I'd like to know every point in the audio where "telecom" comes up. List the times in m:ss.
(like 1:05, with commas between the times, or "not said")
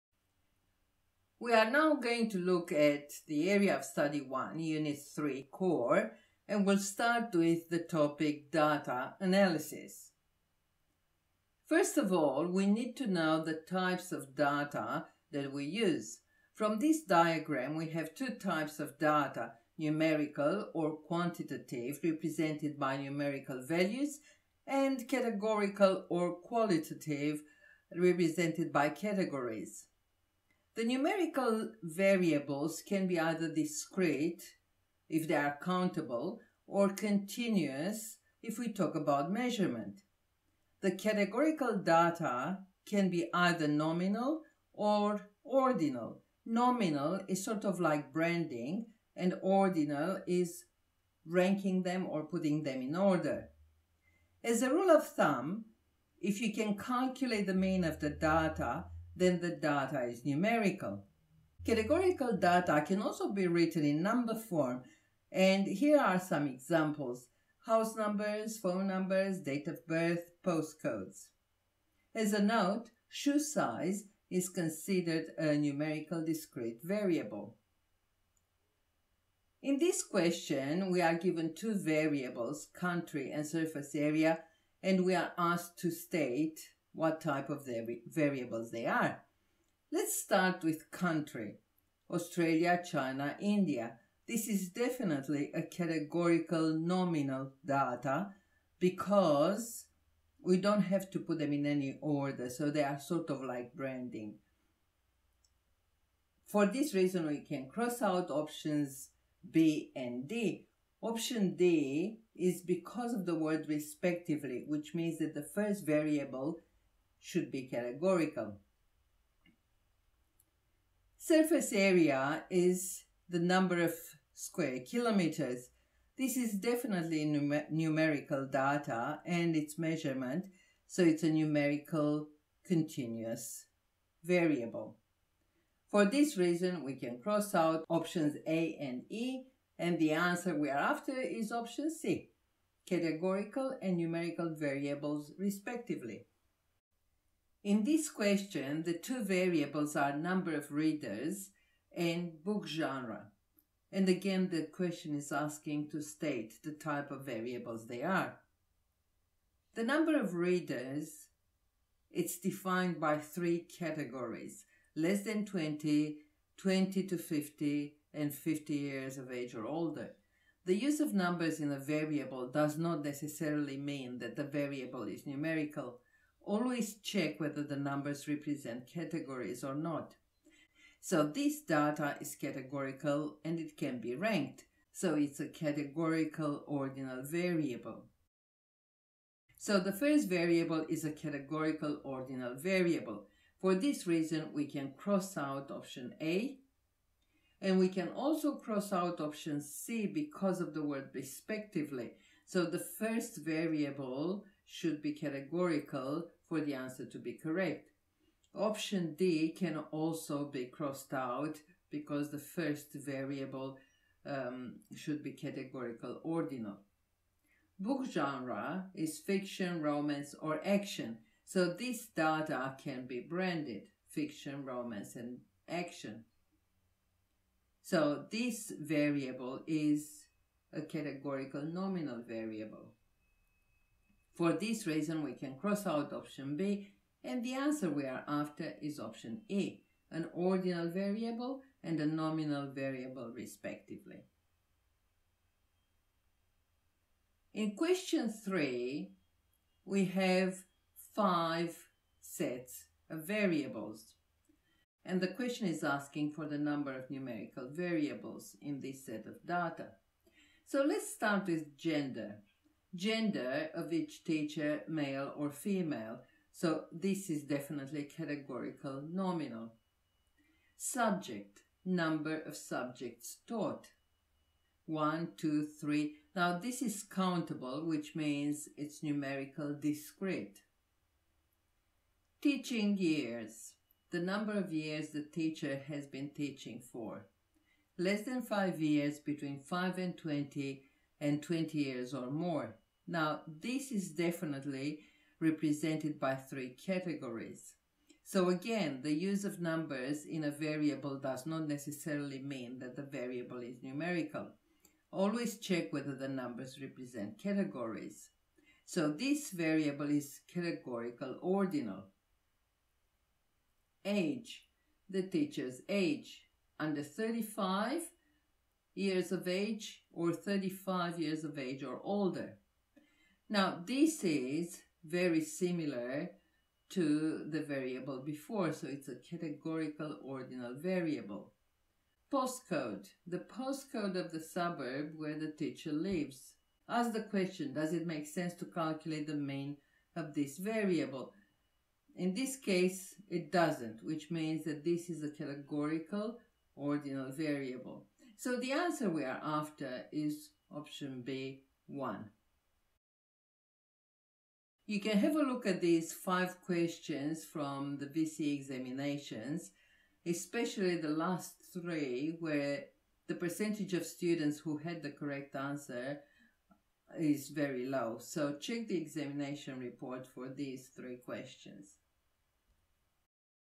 not said.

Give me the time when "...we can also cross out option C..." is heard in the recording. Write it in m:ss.
3:17.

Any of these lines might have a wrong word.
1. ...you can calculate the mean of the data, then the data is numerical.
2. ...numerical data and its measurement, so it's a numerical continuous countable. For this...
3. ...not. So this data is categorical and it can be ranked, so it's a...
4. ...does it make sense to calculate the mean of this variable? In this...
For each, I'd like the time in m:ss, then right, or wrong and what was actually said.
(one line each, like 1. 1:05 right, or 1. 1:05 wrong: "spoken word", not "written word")
1. 0:56 right
2. 2:07 wrong: "variable", not "countable"
3. 2:59 right
4. 5:37 right.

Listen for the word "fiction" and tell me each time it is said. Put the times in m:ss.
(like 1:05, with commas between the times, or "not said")
3:39, 3:44.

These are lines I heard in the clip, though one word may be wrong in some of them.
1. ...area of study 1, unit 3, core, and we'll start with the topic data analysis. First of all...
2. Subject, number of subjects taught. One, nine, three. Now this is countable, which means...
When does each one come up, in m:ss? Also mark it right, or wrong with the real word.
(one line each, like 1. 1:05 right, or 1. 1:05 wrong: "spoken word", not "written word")
1. 0:03 right
2. 4:30 wrong: "two", not "nine".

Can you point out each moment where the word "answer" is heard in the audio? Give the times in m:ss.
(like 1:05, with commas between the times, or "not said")
2:20, 3:26, 3:57, 5:48, 6:05.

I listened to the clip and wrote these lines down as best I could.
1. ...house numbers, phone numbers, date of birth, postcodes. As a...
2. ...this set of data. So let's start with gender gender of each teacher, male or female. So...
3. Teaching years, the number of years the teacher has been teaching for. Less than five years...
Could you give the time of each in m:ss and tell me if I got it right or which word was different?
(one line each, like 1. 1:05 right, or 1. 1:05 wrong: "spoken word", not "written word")
1. 1:07 right
2. 4:18 right
3. 4:42 right.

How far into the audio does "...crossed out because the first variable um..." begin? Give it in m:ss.
3:30.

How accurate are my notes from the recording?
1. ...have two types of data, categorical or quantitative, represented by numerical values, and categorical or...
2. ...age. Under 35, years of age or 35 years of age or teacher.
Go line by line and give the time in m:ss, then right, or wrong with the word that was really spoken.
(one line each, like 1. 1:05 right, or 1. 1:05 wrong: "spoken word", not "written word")
1. 0:17 wrong: "numerical", not "categorical"
2. 5:15 wrong: "older", not "teacher".